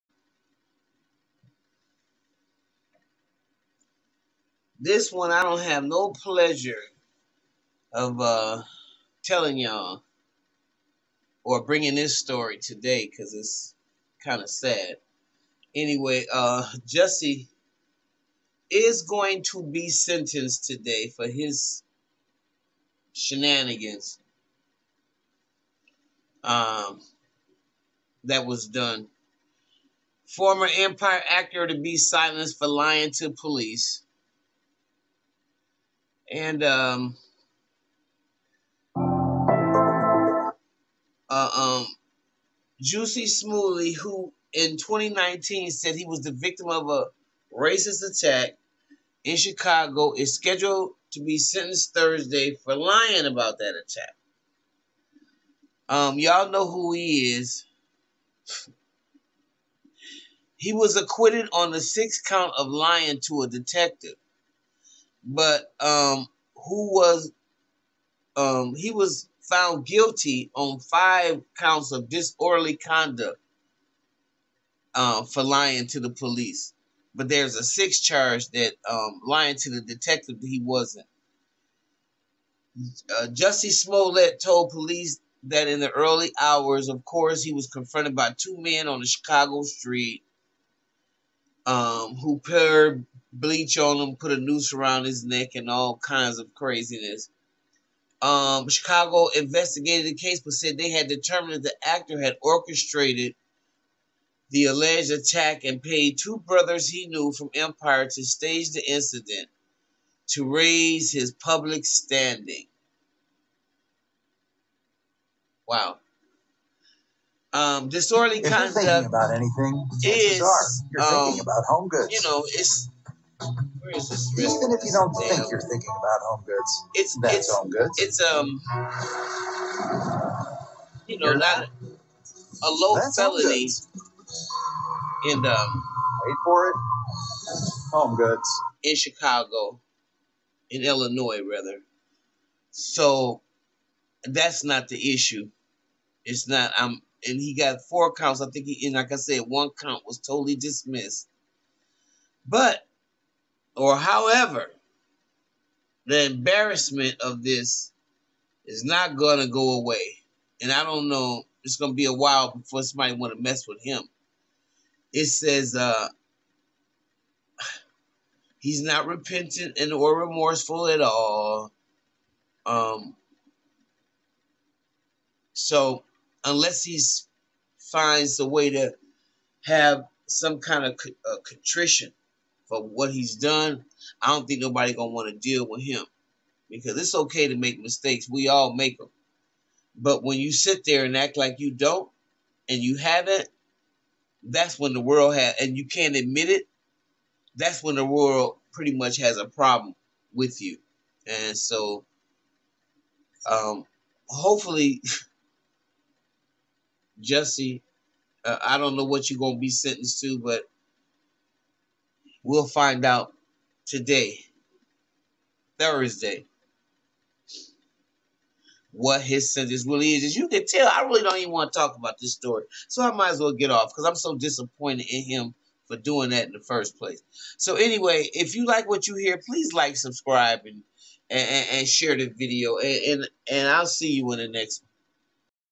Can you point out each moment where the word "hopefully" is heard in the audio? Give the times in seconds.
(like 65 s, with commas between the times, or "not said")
204 s.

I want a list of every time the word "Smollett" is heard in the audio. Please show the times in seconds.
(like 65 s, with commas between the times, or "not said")
43 s, 83 s.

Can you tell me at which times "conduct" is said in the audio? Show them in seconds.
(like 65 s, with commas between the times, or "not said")
72 s, 118 s.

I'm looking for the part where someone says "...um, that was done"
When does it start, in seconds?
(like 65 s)
26 s.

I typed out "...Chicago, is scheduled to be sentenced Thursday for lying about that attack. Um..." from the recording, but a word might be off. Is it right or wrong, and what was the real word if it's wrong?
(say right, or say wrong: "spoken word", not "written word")
right.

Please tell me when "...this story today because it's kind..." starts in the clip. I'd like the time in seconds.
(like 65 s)
11 s.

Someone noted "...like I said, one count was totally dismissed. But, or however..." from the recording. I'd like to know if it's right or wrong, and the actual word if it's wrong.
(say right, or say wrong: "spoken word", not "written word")
right.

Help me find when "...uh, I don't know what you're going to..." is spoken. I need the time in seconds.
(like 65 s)
208 s.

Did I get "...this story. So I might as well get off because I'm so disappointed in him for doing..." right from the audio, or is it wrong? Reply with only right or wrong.
right.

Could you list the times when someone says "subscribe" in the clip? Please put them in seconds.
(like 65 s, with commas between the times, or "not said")
229 s.